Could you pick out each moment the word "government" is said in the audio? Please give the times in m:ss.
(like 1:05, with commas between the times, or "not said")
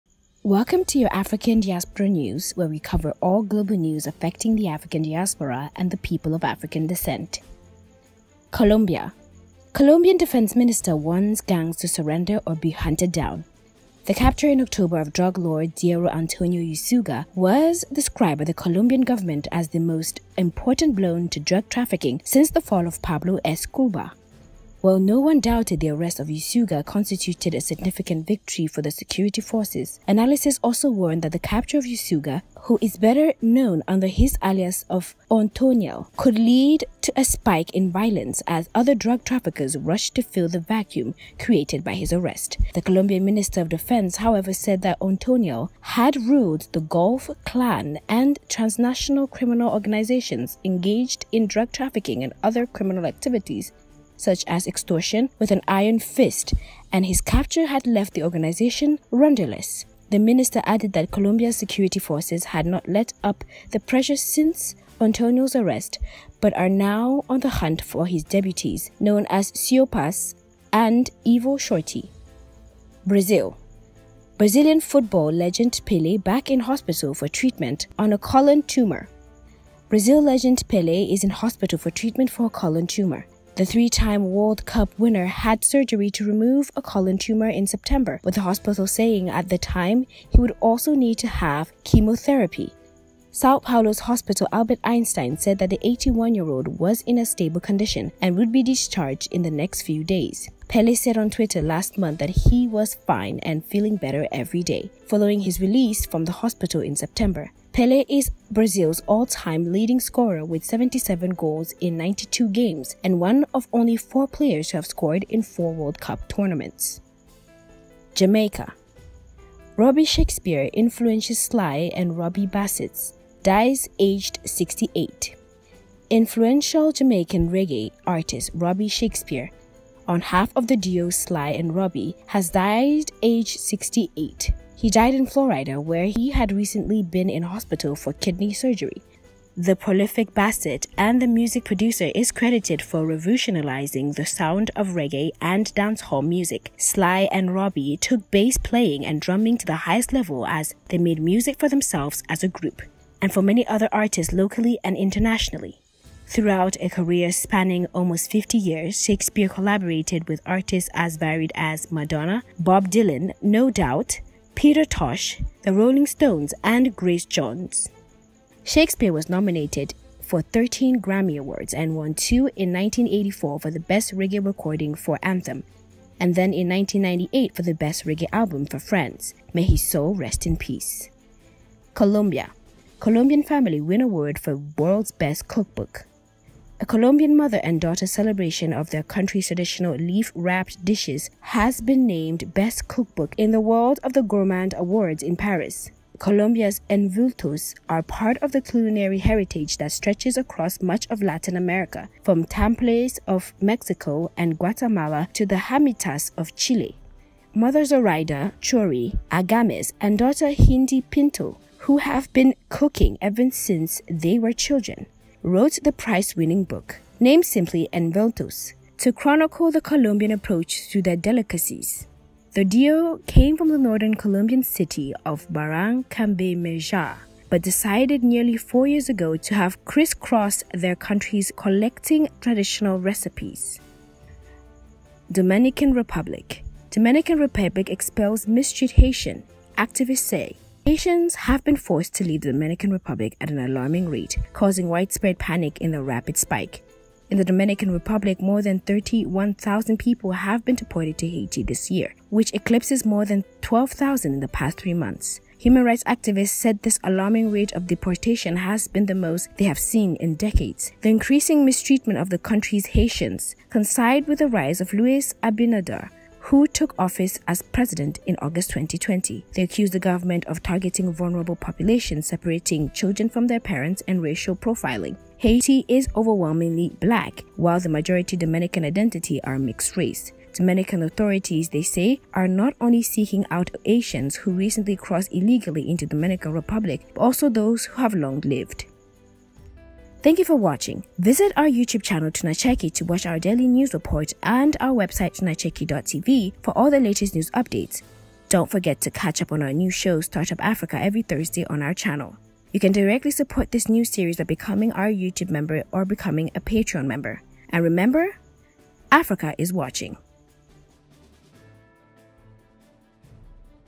0:19, 4:30.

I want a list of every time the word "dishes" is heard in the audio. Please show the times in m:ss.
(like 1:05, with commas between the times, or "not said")
3:10.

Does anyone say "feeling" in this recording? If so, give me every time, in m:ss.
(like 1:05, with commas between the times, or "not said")
1:43.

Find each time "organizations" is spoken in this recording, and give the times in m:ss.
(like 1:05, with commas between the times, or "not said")
0:49, 0:58.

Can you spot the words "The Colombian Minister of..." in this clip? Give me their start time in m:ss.
0:42.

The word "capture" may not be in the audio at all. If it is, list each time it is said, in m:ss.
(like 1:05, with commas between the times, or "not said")
0:14, 0:31, 0:57.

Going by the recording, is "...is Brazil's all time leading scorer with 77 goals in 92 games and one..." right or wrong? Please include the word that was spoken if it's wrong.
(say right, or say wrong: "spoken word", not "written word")
right.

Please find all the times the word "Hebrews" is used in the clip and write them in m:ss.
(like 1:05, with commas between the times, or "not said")
not said.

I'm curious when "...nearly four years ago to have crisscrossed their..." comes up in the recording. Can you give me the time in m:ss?
3:48.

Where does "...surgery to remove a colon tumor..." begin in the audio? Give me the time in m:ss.
1:25.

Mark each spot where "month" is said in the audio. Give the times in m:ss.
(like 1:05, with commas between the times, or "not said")
1:41, 4:14.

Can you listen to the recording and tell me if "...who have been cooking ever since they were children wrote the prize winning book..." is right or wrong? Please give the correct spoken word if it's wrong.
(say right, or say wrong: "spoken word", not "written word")
right.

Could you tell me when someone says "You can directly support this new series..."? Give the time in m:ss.
5:02.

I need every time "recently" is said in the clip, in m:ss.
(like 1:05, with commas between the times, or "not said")
2:16, 4:44.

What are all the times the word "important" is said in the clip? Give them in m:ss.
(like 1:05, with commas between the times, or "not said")
0:20.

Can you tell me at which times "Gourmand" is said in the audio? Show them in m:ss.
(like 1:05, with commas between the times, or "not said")
3:14.